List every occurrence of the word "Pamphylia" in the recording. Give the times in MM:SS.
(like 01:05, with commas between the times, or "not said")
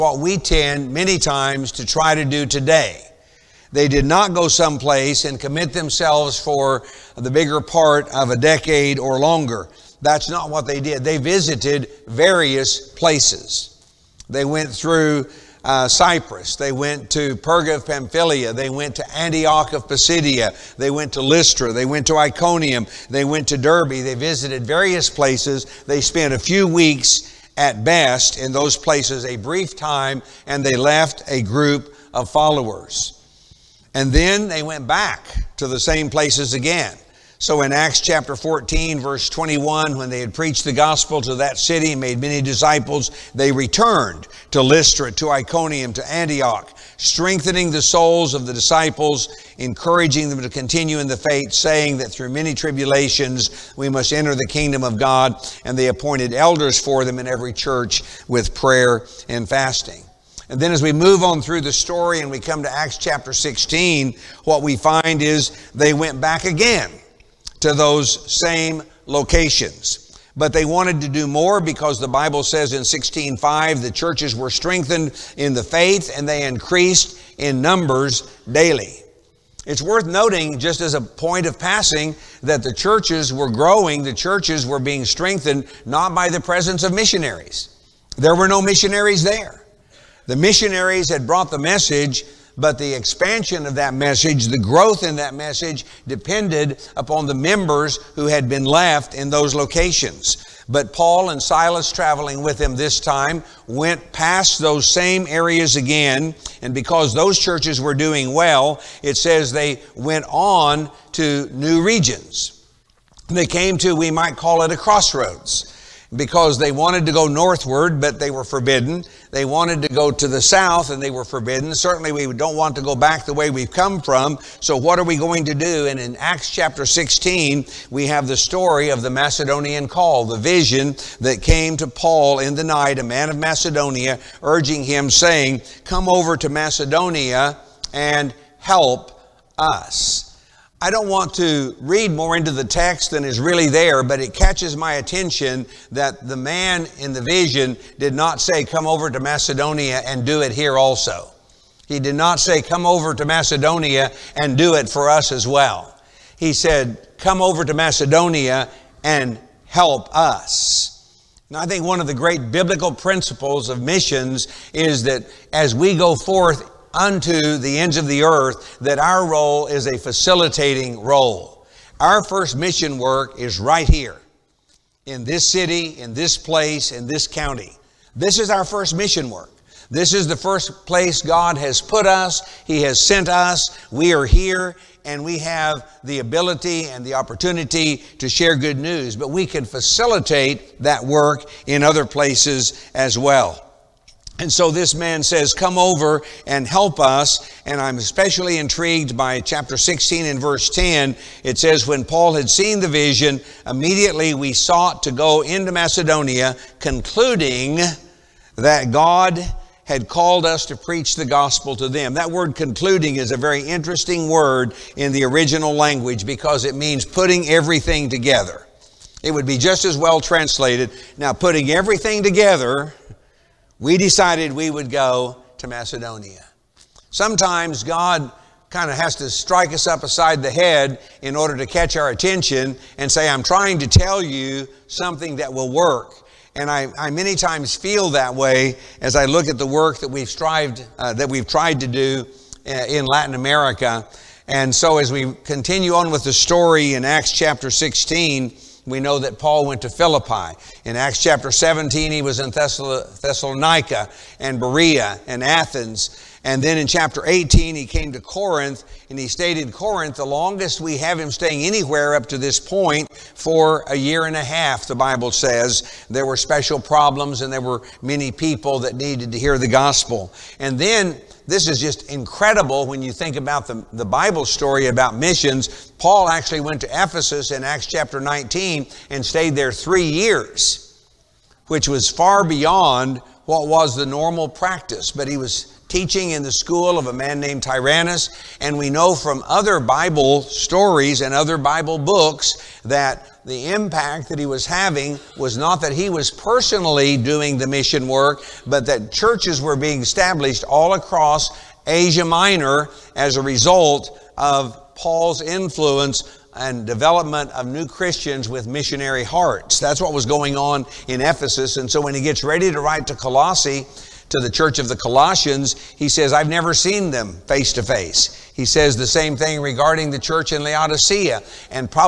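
00:17.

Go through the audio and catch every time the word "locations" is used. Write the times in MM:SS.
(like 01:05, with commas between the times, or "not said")
01:09, 01:39.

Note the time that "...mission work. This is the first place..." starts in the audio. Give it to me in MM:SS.
02:58.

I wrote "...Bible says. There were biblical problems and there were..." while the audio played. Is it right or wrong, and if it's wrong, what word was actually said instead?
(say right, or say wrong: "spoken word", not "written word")
wrong: "special", not "biblical".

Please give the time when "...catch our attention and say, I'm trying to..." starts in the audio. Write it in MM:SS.
03:51.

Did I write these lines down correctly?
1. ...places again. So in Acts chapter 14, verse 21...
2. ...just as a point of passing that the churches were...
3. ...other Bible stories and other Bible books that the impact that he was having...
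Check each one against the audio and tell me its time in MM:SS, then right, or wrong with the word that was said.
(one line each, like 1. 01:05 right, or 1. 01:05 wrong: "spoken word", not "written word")
1. 00:36 right
2. 01:20 right
3. 04:49 right.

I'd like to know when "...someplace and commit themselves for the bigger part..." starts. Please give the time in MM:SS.
00:04.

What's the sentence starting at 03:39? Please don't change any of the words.
It would be just as well translated.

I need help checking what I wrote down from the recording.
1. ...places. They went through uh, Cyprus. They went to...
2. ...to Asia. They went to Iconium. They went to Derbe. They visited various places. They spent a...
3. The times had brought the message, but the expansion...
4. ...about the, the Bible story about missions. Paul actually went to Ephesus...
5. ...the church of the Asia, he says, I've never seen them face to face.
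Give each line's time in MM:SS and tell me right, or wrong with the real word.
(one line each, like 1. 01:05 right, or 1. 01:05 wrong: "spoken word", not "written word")
1. 00:12 right
2. 00:21 wrong: "Lystra", not "Asia"
3. 01:30 wrong: "missionaries", not "times"
4. 04:33 right
5. 05:14 wrong: "Colossians", not "Asia".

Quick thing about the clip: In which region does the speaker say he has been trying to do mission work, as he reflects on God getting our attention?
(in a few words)
Latin America.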